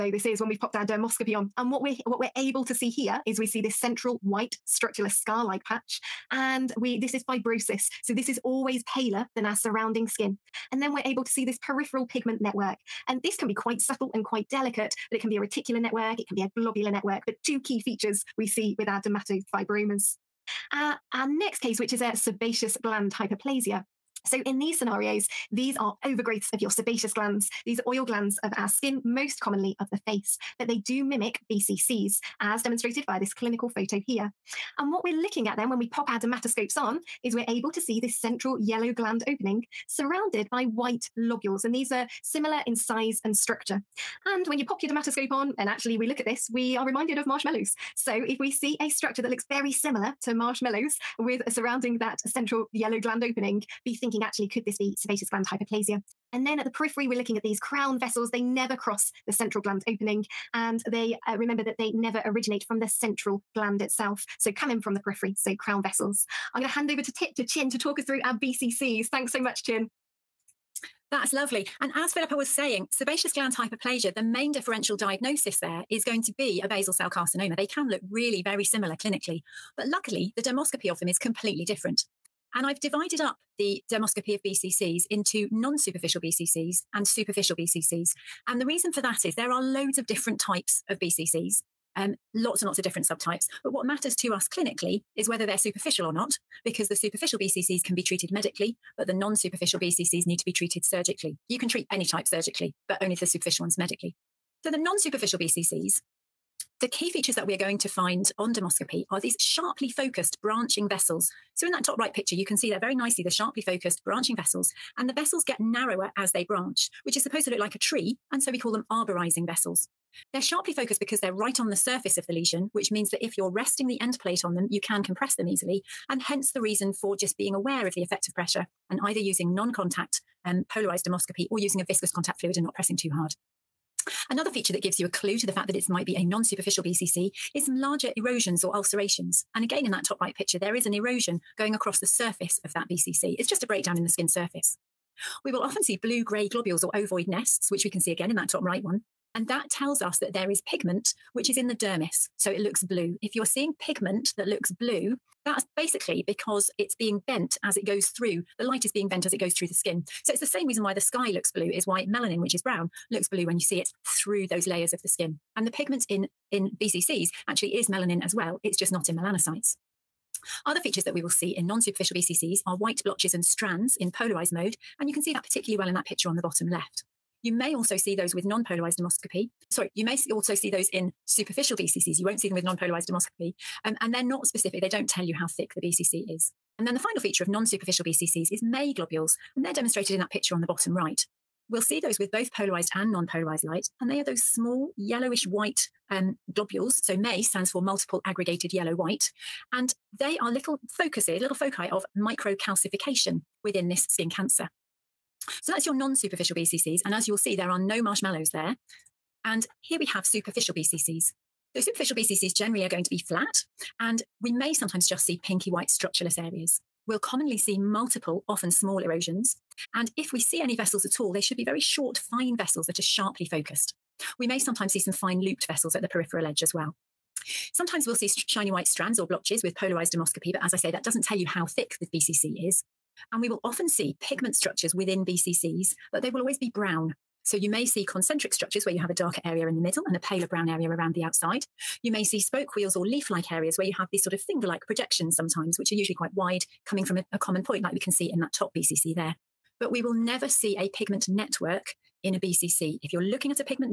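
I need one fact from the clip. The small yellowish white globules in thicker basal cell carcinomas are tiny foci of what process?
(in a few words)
Microcalcification.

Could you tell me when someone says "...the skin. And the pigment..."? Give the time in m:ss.
2:45.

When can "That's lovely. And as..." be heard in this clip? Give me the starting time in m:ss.
1:11.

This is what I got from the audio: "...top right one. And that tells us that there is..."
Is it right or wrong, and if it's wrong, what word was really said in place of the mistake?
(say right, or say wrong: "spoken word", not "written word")
right.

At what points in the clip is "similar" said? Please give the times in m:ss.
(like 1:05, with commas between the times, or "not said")
0:42, 0:49, 1:18.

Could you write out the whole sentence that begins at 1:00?
And they uh, remember that they never originate from the central gland itself.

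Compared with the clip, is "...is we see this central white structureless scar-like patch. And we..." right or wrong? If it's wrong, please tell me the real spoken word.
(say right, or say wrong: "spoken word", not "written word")
right.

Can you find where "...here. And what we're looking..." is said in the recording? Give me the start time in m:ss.
0:34.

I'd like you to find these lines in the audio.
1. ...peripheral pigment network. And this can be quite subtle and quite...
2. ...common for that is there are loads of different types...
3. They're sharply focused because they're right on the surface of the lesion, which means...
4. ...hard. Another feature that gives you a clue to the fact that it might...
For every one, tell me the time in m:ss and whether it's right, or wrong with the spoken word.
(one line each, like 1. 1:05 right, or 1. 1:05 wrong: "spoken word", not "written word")
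1. 0:11 right
2. 1:28 wrong: "reason", not "common"
3. 2:00 right
4. 2:13 right.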